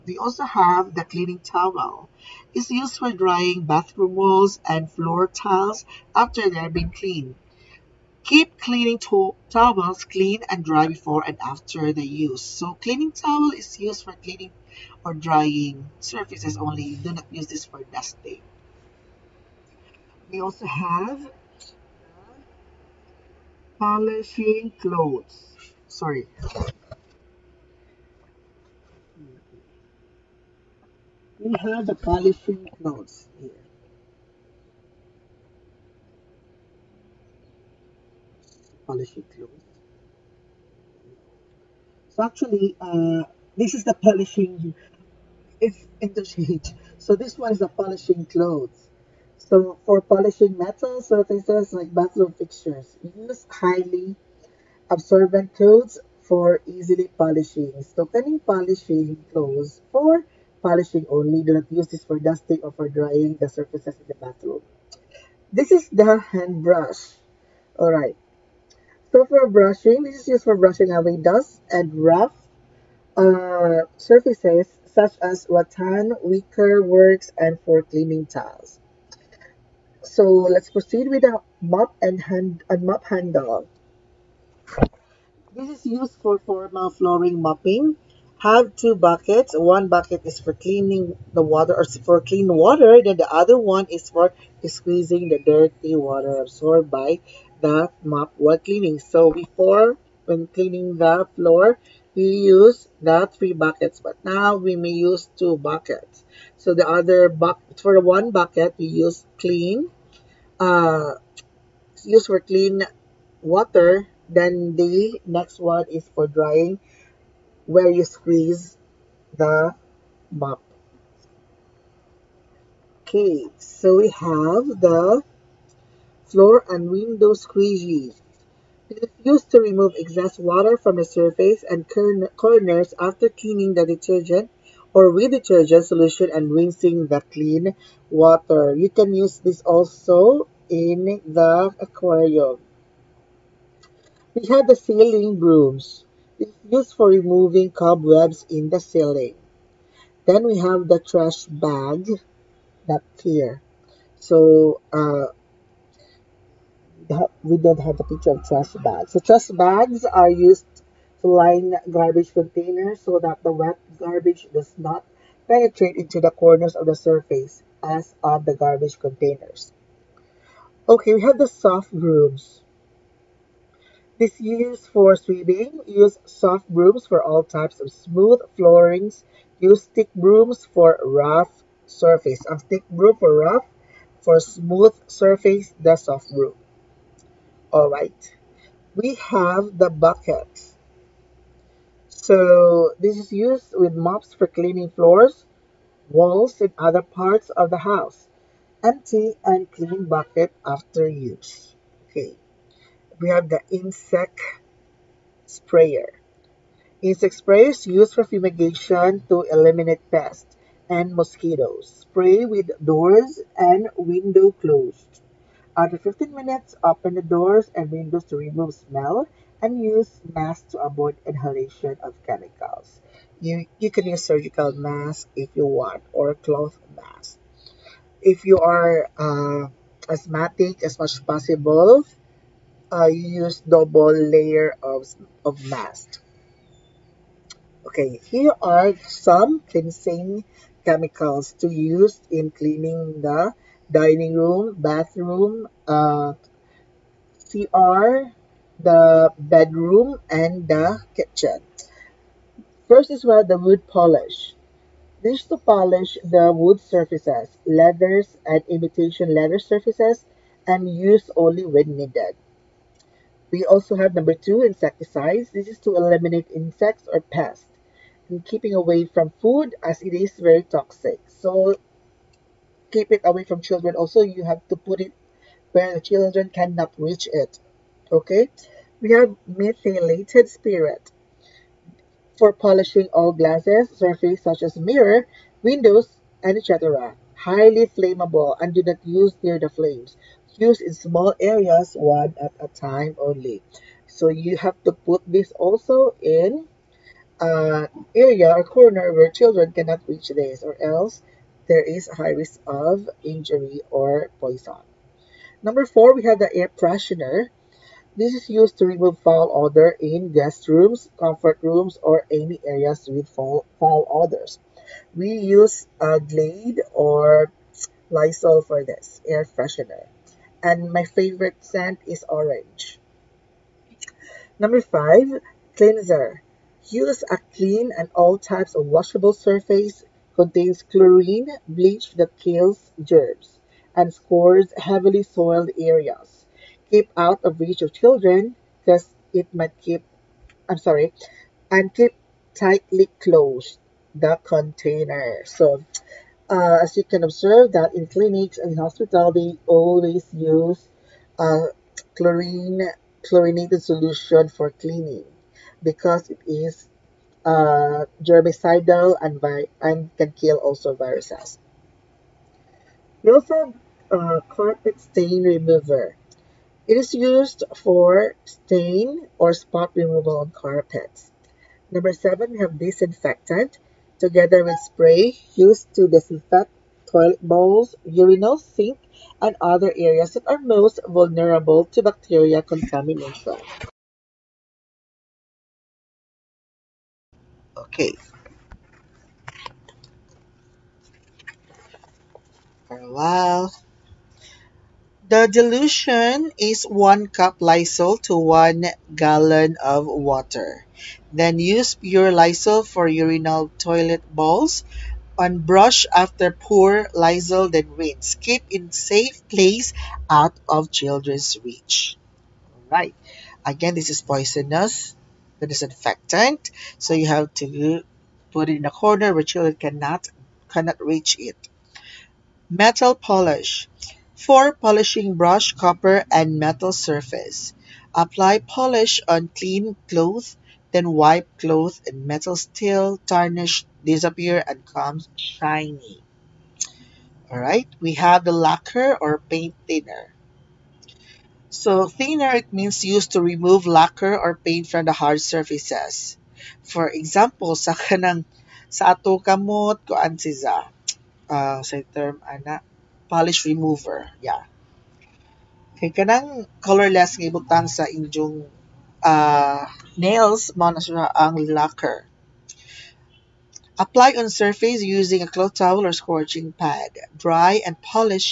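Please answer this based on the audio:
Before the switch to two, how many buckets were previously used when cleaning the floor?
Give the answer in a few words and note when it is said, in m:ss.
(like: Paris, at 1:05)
3, at 1:43.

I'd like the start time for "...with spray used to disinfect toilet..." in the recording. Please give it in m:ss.
6:14.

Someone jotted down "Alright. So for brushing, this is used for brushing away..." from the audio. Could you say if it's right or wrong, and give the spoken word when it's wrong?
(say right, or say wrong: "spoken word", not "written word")
right.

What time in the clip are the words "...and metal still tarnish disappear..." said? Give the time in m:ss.
7:12.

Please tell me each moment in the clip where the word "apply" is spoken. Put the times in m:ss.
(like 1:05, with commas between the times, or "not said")
7:08, 7:43.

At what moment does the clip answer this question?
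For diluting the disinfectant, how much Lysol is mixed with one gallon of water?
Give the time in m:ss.
6:36.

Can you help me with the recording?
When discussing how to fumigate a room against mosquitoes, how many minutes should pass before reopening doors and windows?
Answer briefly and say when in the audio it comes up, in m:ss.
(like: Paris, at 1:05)
15, at 3:35.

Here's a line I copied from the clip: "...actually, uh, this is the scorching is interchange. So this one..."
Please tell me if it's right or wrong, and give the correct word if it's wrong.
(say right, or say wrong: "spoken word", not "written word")
wrong: "polishing", not "scorching".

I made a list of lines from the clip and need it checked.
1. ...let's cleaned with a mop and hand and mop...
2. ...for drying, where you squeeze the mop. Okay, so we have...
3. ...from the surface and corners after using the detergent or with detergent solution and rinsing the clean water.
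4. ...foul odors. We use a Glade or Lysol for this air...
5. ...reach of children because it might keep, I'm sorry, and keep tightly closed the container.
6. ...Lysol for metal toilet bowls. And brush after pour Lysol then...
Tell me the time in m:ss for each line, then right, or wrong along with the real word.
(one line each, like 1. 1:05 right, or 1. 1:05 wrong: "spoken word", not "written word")
1. 1:20 wrong: "proceed", not "cleaned"
2. 1:56 right
3. 2:10 wrong: "cleaning", not "using"
4. 5:13 right
5. 5:37 right
6. 6:42 wrong: "urinal", not "metal".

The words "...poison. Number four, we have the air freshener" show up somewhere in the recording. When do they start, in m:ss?
5:04.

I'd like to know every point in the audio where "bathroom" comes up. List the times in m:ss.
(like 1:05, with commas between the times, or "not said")
0:03, 0:51, 1:04, 4:04.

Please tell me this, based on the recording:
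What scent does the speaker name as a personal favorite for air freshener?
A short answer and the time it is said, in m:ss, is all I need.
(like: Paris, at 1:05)
Orange, at 5:22.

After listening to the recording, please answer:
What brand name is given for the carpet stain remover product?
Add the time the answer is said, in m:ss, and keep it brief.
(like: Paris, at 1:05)
Milford, at 6:03.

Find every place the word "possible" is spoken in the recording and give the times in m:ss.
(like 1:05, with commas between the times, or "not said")
3:51.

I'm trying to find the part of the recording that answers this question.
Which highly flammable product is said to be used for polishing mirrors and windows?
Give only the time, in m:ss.
4:39.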